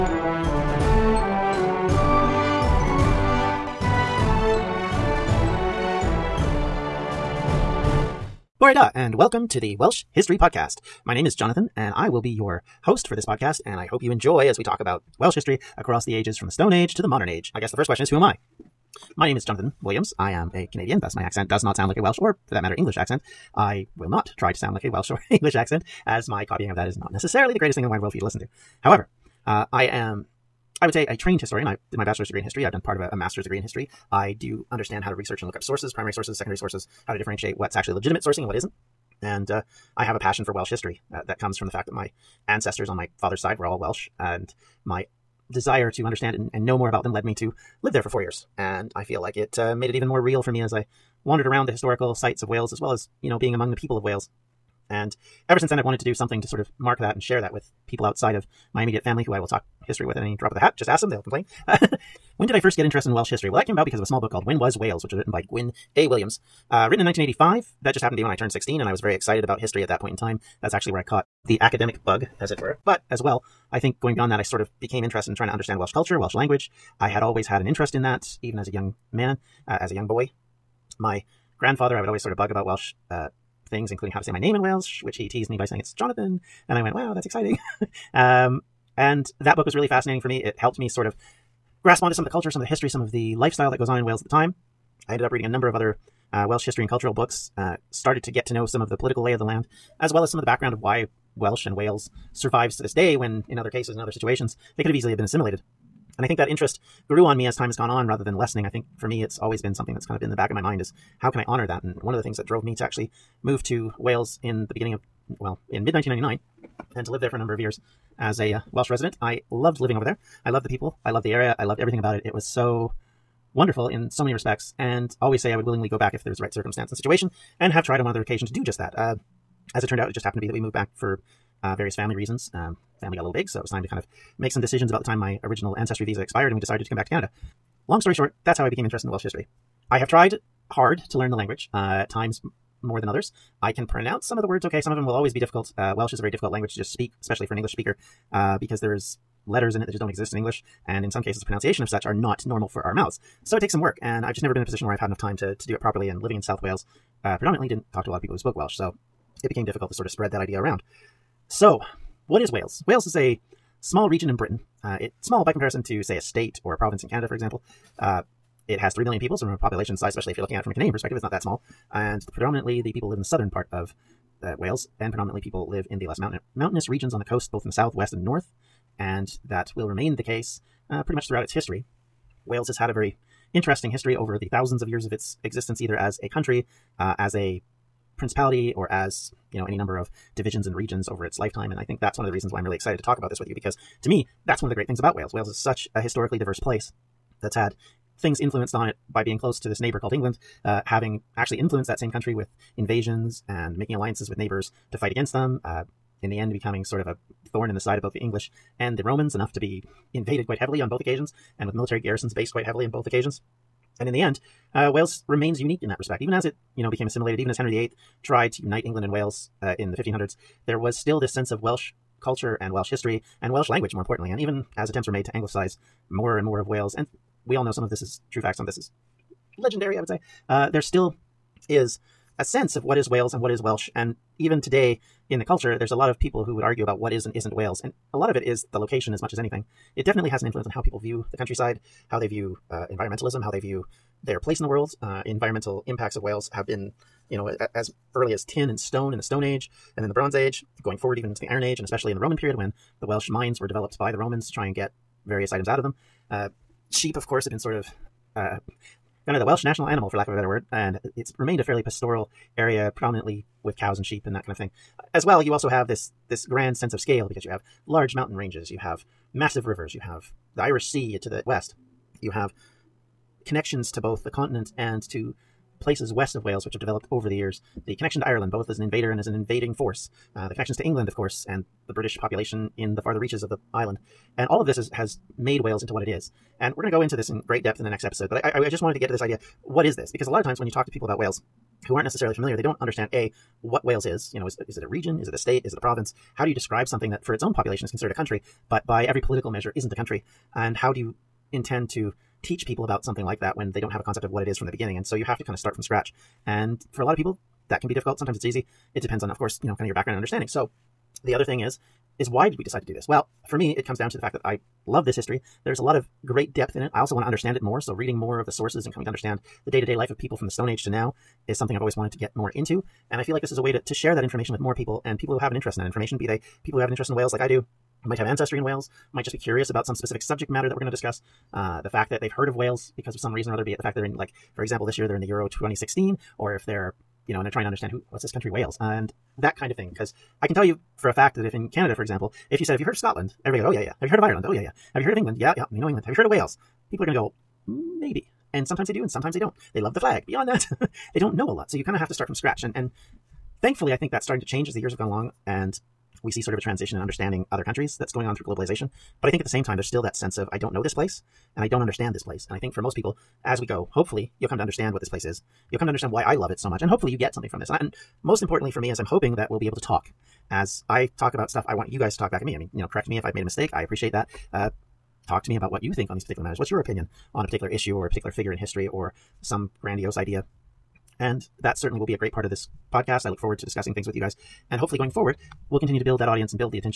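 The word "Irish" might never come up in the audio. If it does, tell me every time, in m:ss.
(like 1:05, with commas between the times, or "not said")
4:30.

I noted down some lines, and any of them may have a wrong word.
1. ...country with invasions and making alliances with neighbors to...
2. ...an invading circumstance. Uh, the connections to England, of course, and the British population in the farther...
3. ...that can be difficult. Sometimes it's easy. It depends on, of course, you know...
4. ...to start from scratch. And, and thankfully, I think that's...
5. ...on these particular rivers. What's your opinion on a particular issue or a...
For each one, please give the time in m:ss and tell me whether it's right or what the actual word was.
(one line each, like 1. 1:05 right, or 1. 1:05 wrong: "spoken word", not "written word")
1. 3:22 right
2. 4:39 wrong: "force", not "circumstance"
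3. 5:07 right
4. 5:52 right
5. 6:16 wrong: "matters", not "rivers".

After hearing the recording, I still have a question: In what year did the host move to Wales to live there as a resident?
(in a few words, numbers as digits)
1999.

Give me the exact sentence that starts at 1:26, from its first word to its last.
And I went, wow, that's exciting.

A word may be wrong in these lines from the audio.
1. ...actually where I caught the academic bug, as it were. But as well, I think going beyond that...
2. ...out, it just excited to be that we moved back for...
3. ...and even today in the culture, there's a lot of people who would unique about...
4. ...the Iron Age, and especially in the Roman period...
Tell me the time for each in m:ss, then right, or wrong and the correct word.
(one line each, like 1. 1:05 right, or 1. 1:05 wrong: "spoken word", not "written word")
1. 1:10 right
2. 2:09 wrong: "happened", not "excited"
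3. 3:53 wrong: "argue", not "unique"
4. 4:11 right.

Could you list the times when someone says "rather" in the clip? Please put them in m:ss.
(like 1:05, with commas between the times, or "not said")
1:48.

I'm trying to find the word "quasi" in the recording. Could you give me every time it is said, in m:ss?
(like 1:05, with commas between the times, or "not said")
not said.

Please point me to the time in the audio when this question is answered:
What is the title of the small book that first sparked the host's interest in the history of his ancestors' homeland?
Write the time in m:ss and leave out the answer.
1:04.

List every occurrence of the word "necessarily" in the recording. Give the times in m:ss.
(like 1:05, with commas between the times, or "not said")
0:27, 4:52.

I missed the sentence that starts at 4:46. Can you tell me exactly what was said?
And we're going to go into this in great depth in the next episode.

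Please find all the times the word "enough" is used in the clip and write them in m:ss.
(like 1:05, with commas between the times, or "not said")
2:35, 3:29.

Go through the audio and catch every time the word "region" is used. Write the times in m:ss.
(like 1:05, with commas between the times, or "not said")
2:44, 2:56, 3:10, 4:54.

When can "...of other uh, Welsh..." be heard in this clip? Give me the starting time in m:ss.
1:35.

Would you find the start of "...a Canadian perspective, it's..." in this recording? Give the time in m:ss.
2:50.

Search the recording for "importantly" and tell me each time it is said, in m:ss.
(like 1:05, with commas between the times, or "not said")
3:44, 6:08.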